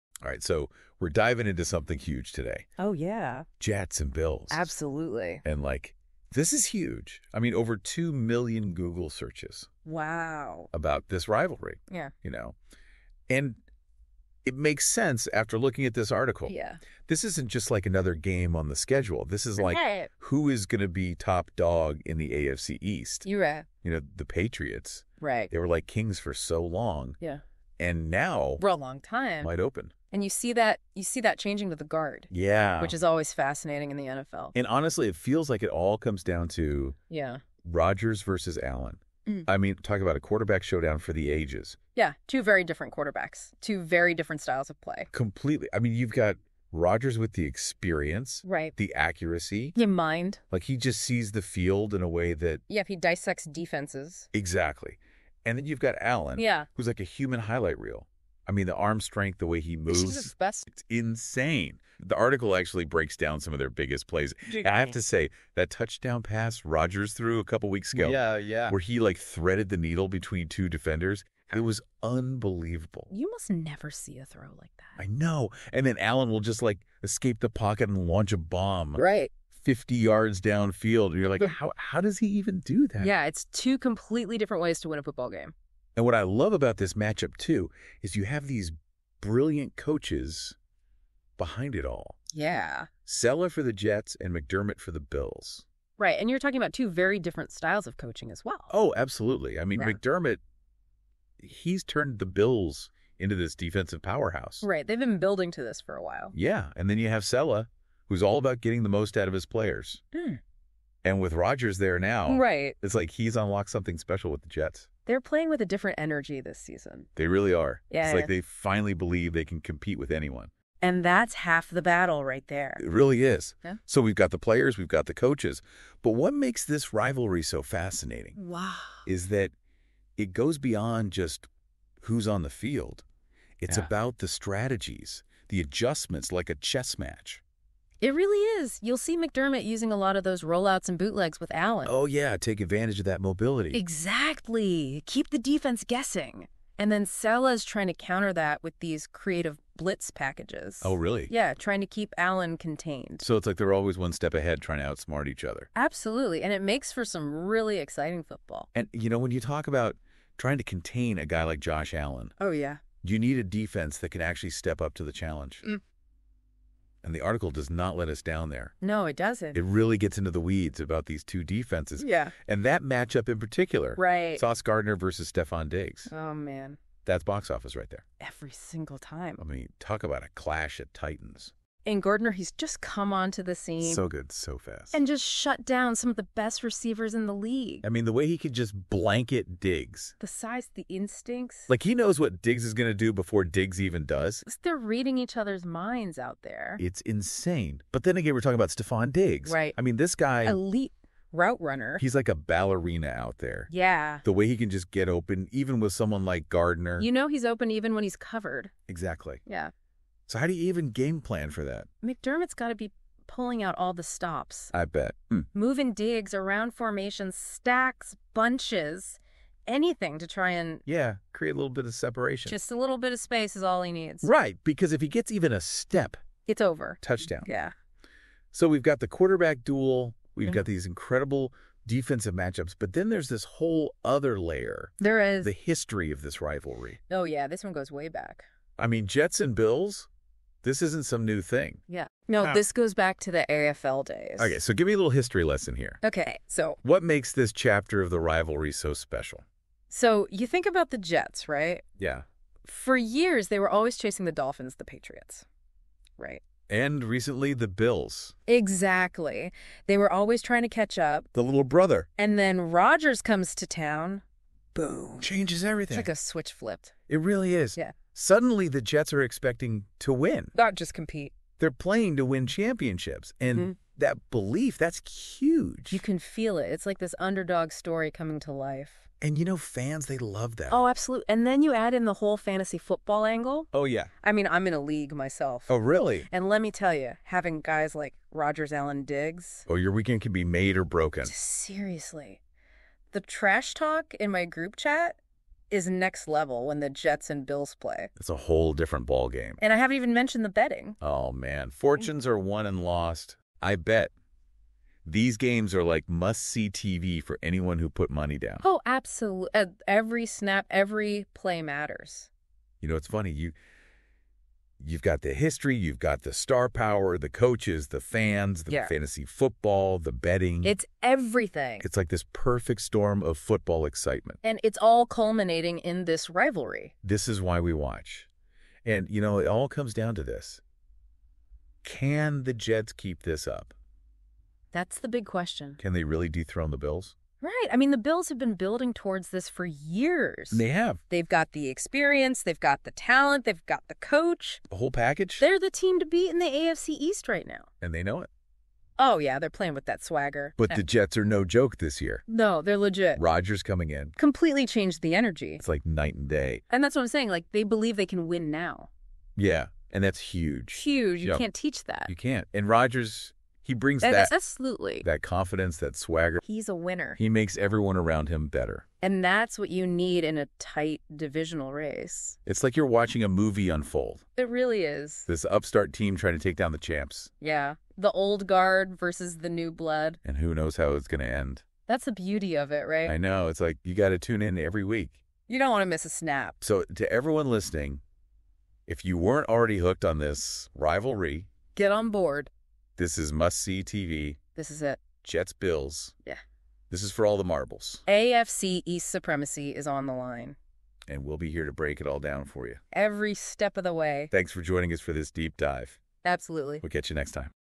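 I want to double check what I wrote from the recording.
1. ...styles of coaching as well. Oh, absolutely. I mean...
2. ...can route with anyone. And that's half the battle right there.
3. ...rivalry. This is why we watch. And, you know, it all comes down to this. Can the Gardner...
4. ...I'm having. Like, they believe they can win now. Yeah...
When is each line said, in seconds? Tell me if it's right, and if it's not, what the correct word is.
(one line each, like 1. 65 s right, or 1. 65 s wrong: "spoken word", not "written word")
1. 97 s right
2. 119 s wrong: "compete", not "route"
3. 326 s wrong: "Jets", not "Gardner"
4. 357 s wrong: "saying", not "having".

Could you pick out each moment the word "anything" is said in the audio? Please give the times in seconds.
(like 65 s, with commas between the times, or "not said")
219 s.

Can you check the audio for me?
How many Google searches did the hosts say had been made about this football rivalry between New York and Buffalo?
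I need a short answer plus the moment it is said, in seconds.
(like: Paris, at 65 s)
over 2 million, at 7 s.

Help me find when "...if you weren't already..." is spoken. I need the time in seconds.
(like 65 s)
388 s.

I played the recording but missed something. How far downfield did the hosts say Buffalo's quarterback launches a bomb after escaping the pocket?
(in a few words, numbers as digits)
50 yards.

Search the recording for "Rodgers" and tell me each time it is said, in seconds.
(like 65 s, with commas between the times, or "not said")
37 s, 46 s, 66 s, 111 s, 262 s, 288 s, 353 s, 362 s.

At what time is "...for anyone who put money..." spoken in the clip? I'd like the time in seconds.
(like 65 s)
307 s.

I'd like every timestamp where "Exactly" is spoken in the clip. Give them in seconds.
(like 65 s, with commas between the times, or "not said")
54 s, 143 s, 208 s, 258 s.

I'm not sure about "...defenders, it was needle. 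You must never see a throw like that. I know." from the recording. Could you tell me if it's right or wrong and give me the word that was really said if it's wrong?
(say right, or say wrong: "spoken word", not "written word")
wrong: "unbelievable", not "needle".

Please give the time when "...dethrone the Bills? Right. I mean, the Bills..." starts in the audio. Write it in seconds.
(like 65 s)
336 s.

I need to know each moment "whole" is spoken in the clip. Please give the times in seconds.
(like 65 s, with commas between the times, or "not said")
233 s, 282 s, 298 s, 344 s.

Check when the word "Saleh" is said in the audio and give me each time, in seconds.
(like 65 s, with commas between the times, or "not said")
93 s, 107 s, 147 s.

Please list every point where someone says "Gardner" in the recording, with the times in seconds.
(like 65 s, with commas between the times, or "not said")
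174 s, 182 s, 206 s.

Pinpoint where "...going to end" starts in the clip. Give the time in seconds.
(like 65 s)
381 s.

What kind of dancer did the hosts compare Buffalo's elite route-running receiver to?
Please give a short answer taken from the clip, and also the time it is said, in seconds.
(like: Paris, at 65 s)
ballerina, at 202 s.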